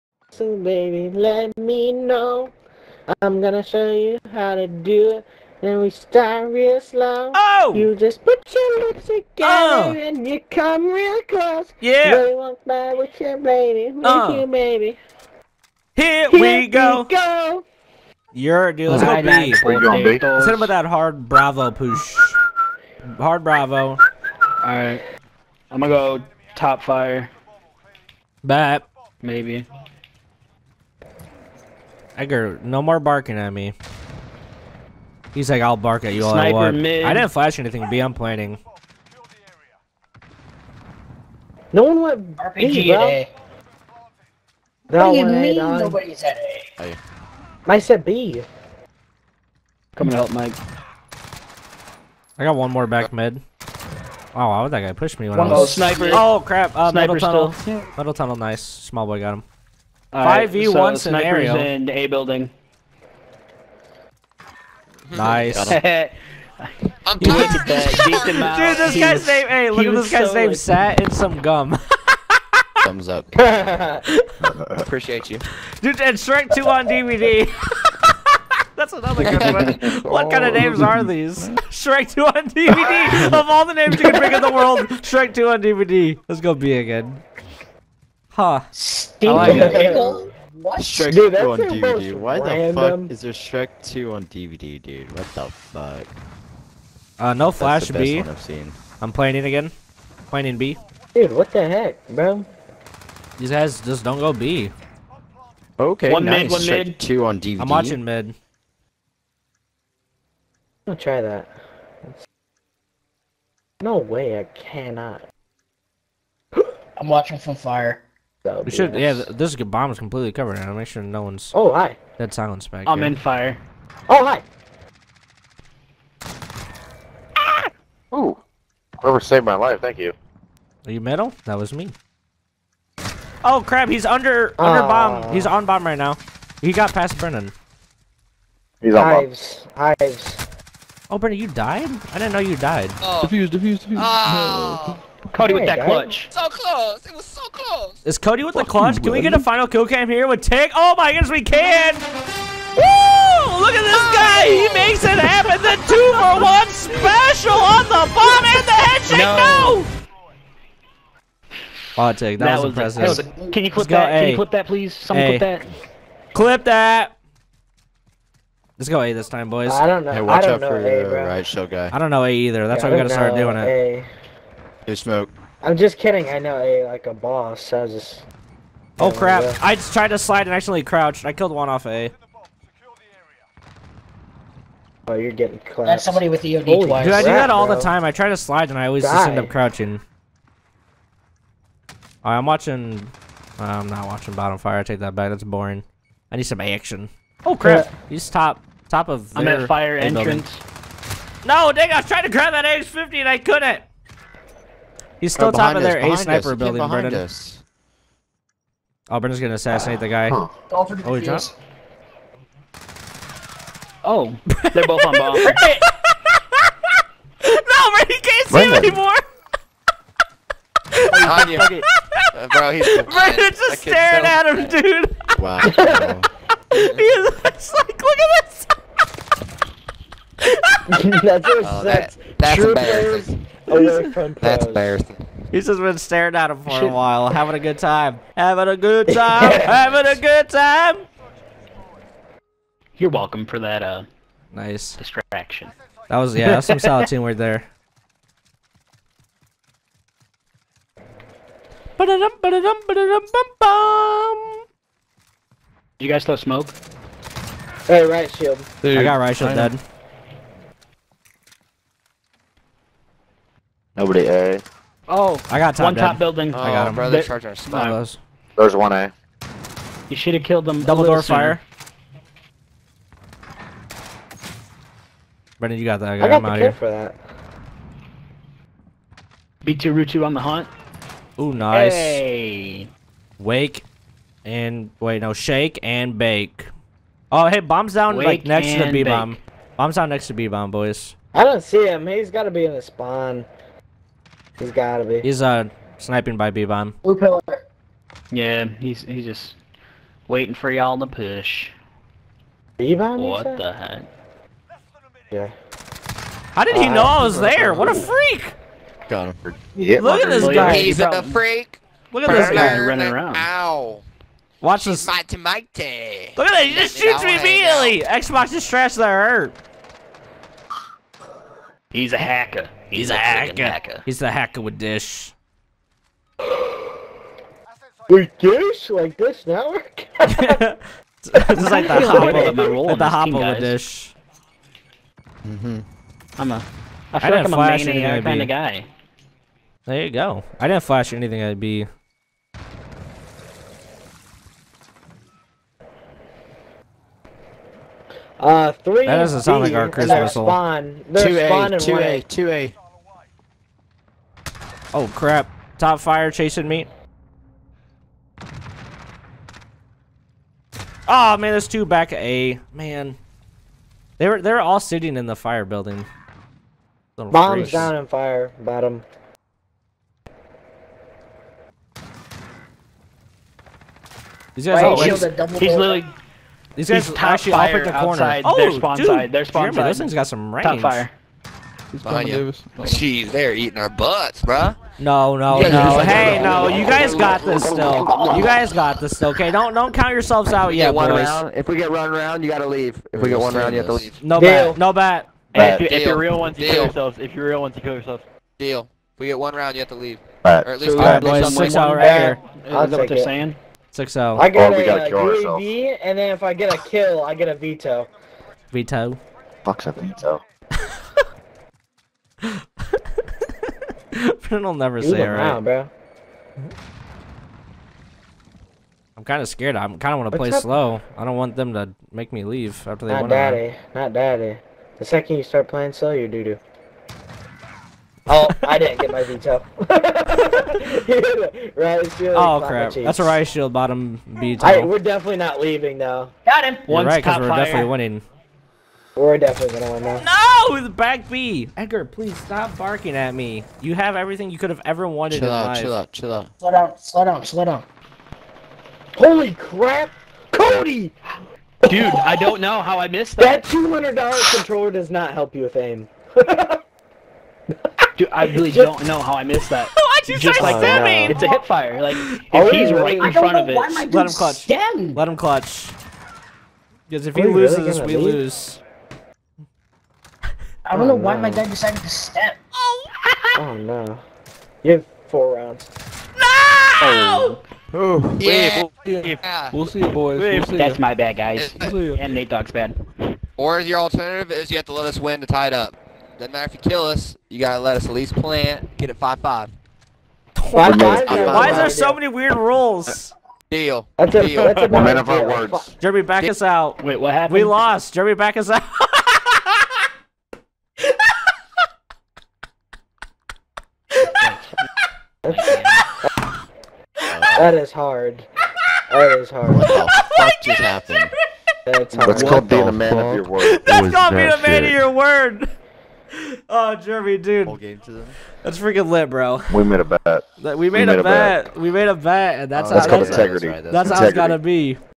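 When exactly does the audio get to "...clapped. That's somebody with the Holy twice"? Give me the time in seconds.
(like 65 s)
185 s.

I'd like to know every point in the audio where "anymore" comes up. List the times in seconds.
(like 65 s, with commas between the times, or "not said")
218 s.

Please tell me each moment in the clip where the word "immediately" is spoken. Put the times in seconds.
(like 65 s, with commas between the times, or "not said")
317 s.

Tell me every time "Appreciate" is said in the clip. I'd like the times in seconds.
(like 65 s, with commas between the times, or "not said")
74 s.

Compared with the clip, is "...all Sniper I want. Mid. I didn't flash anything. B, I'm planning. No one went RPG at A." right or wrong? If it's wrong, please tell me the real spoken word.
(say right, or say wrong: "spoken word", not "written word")
right.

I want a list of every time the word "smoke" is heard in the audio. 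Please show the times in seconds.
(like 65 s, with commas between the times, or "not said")
174 s, 256 s.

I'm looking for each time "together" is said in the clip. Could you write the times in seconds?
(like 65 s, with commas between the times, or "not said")
9 s.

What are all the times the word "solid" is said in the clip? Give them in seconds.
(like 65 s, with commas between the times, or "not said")
246 s.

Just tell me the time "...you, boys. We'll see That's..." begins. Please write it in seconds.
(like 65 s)
479 s.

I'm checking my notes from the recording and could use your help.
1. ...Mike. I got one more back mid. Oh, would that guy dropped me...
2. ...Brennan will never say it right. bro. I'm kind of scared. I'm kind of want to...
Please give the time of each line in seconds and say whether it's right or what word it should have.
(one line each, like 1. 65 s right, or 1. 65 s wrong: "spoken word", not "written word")
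1. 50 s wrong: "pushed", not "dropped"
2. 414 s right.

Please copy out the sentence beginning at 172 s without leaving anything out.
That's yeah, why we gotta start doing it.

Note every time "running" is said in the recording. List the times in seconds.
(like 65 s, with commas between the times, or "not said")
312 s.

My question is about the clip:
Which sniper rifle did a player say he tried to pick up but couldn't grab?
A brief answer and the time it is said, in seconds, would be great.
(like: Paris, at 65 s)
AX50, at 202 s.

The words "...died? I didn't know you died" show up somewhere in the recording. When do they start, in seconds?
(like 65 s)
141 s.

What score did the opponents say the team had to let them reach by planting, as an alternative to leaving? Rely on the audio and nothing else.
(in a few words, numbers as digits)
5-5.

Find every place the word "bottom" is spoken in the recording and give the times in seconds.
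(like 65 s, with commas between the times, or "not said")
194 s, 368 s, 433 s.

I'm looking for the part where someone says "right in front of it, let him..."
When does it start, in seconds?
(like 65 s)
463 s.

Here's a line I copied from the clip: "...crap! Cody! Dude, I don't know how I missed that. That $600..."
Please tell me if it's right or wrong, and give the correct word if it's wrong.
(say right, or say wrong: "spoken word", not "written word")
wrong: "200", not "600".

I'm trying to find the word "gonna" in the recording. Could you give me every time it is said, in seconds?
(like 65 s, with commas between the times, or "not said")
3 s, 25 s, 209 s, 439 s.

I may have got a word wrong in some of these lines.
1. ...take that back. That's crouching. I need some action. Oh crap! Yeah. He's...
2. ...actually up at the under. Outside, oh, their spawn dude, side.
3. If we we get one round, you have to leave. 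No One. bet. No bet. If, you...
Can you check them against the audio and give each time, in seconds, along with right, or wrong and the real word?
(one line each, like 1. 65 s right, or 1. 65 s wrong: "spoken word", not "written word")
1. 194 s wrong: "boring", not "crouching"
2. 377 s wrong: "corner", not "under"
3. 393 s wrong: "Deal", not "One".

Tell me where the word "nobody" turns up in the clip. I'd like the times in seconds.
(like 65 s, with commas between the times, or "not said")
45 s, 264 s.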